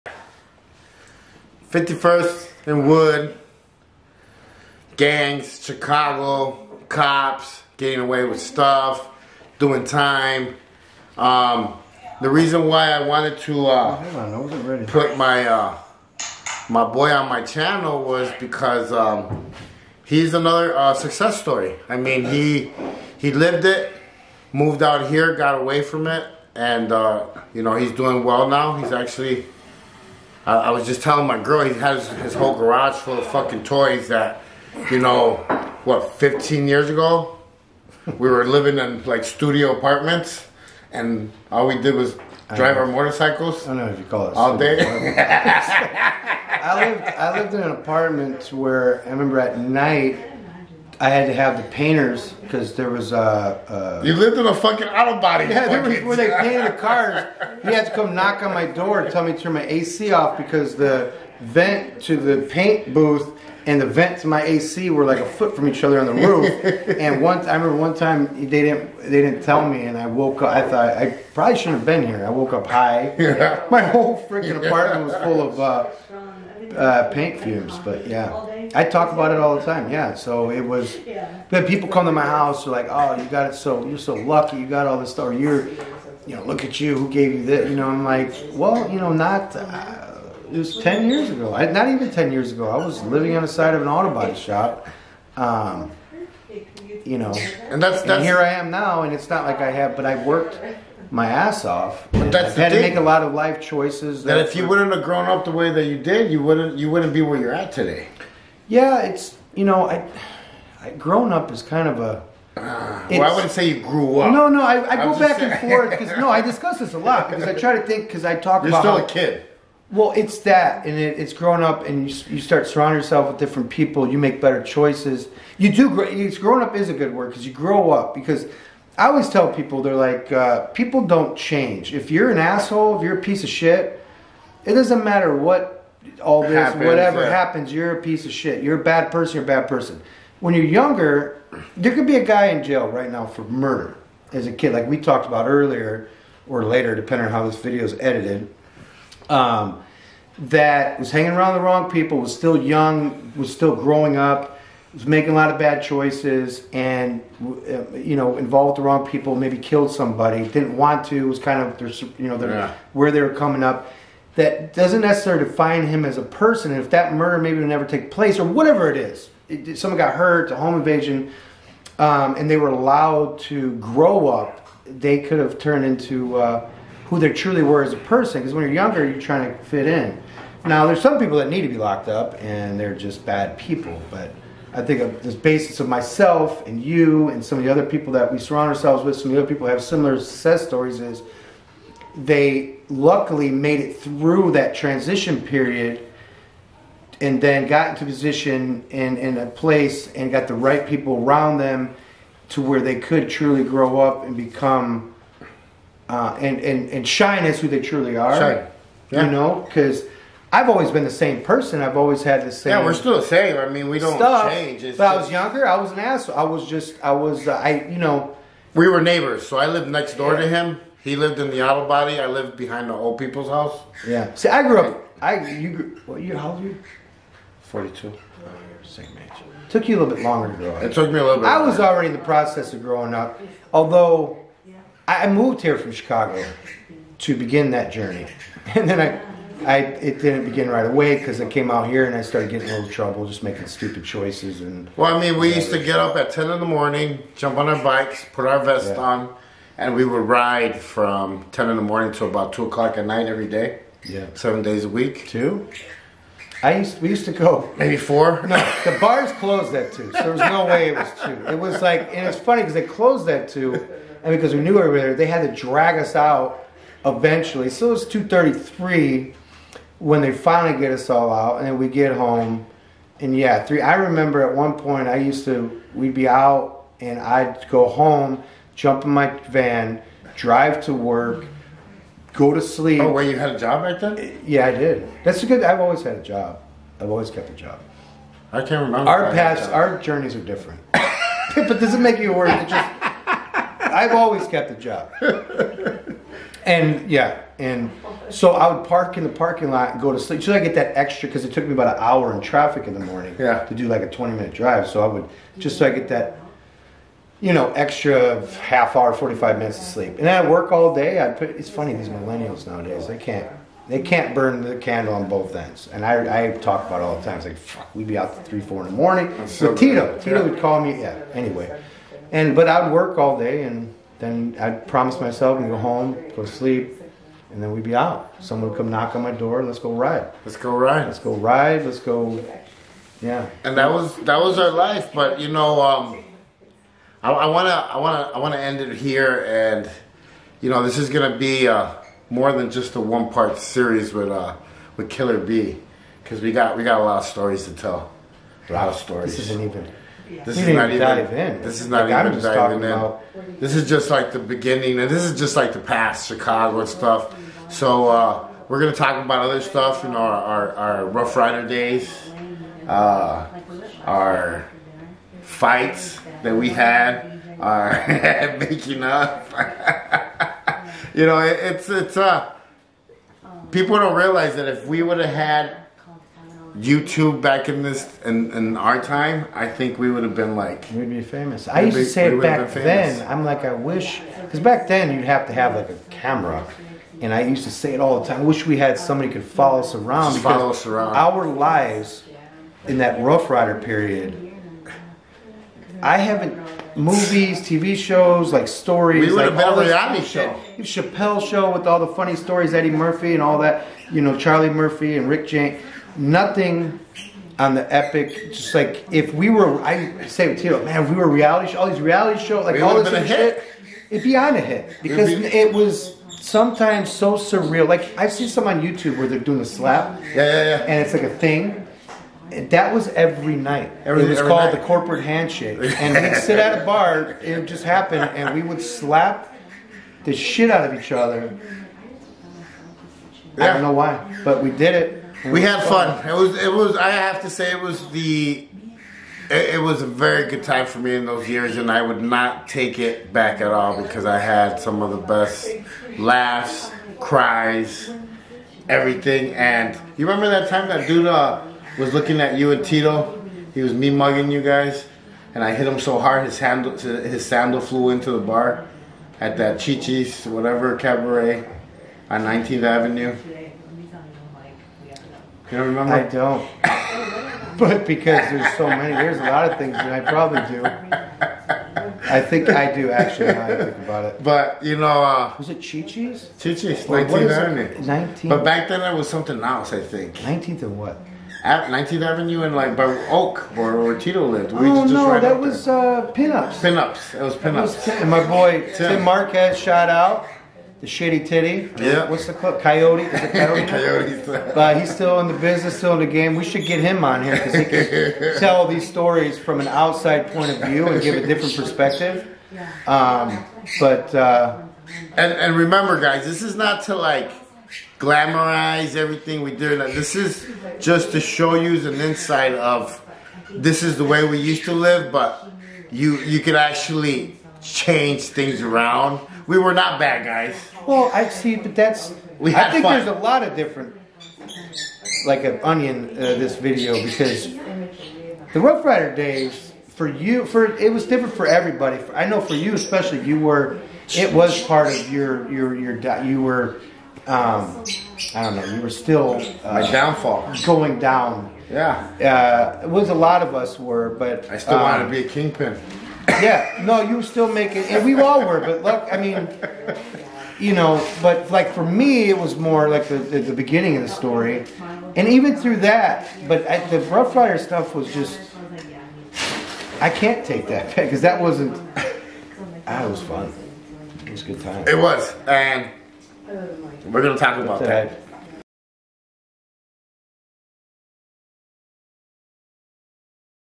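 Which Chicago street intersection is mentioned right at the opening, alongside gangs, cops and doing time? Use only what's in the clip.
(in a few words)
51st and Wood.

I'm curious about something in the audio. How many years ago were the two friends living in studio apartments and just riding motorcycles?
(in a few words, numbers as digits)
15 years.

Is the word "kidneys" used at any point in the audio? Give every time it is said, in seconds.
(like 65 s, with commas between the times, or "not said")
not said.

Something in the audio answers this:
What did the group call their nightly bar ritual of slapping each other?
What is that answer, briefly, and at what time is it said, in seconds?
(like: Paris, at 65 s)
The corporate handshake, at 424 s.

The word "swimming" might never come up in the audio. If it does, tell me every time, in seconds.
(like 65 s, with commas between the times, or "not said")
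not said.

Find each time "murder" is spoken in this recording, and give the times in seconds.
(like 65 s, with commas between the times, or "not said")
143 s, 167 s.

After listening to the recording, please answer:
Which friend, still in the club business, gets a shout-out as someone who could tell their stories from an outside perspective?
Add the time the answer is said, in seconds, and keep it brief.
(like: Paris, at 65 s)
Tim Marquez, at 489 s.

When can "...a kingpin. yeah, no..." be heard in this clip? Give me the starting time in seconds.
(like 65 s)
545 s.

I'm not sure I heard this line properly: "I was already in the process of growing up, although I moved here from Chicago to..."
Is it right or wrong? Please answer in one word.
right.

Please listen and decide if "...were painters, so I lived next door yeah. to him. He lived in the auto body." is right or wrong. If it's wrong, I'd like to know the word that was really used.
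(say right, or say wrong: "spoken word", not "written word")
wrong: "neighbors", not "painters".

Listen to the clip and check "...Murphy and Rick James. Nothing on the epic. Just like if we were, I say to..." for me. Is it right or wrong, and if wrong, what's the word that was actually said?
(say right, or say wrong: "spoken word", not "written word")
right.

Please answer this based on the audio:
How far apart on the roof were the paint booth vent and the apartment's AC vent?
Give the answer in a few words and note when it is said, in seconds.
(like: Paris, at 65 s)
A foot, at 65 s.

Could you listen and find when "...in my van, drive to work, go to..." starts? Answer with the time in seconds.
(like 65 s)
279 s.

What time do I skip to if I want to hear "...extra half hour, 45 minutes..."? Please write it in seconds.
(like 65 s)
307 s.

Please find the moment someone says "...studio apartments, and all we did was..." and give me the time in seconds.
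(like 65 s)
39 s.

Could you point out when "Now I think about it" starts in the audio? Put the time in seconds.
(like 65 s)
473 s.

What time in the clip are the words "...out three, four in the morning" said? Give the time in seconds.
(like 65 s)
318 s.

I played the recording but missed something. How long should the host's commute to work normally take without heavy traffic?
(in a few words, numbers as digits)
20 minutes.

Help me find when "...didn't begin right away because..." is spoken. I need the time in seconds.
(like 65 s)
240 s.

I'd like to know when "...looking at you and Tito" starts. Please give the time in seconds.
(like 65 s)
452 s.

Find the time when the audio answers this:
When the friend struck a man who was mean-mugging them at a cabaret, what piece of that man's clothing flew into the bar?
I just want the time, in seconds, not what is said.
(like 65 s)
457 s.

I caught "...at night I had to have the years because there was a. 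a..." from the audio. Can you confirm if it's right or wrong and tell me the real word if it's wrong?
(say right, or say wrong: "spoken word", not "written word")
wrong: "painters", not "years".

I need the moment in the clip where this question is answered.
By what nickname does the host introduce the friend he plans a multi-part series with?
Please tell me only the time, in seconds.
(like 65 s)
345 s.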